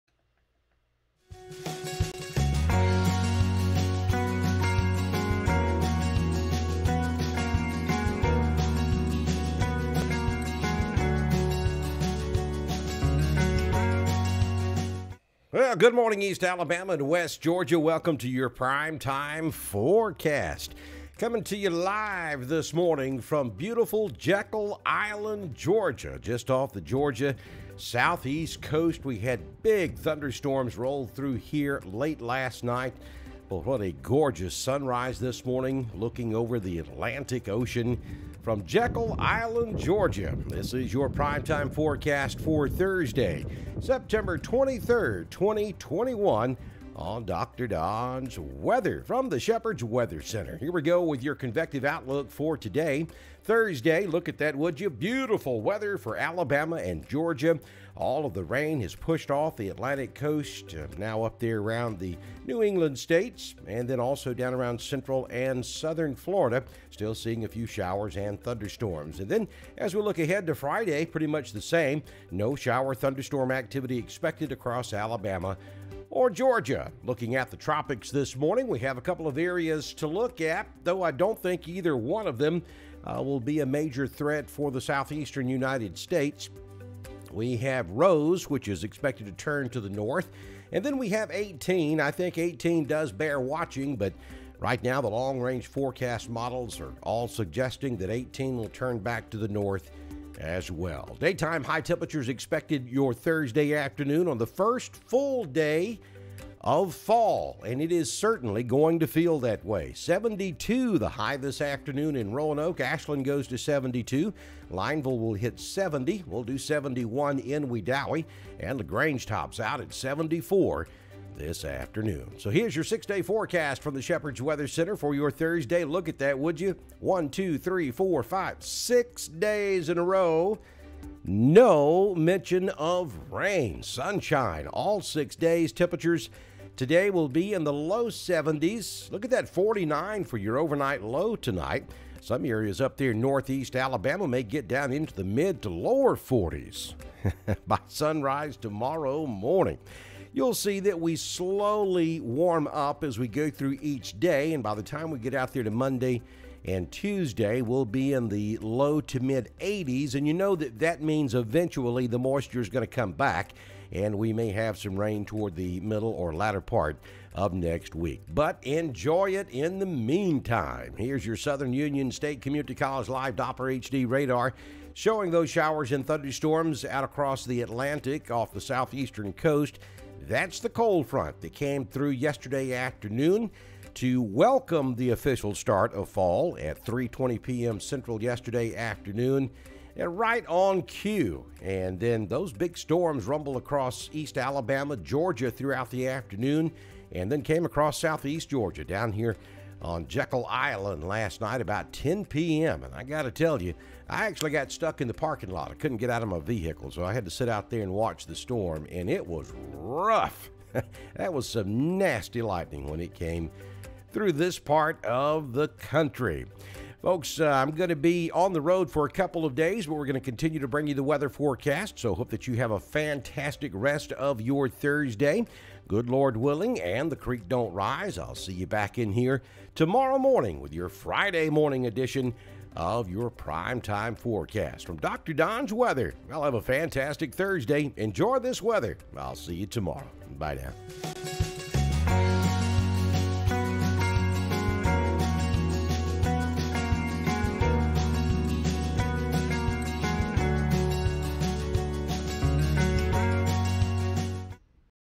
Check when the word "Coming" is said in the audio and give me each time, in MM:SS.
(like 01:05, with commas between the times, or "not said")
00:21.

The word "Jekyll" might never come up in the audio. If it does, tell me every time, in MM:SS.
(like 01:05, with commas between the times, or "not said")
00:24, 00:38, 03:20.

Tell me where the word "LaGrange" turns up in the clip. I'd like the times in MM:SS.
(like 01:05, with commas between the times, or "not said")
01:58.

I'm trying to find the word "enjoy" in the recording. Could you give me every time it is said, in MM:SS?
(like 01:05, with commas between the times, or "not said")
02:48, 03:57.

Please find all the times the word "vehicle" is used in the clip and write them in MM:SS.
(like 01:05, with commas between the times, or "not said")
03:26.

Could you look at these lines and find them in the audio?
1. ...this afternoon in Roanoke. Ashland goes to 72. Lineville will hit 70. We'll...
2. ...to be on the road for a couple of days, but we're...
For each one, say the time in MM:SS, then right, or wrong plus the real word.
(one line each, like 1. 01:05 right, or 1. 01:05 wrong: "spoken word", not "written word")
1. 01:51 right
2. 03:37 right.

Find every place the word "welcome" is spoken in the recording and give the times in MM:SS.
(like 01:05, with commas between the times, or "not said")
00:17, 03:04.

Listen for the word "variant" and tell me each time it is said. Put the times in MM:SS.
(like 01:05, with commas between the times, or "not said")
not said.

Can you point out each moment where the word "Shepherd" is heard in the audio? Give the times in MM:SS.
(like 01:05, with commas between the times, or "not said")
00:49, 02:04.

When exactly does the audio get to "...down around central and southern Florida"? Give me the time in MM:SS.
01:04.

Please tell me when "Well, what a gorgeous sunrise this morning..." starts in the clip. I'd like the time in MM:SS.
00:33.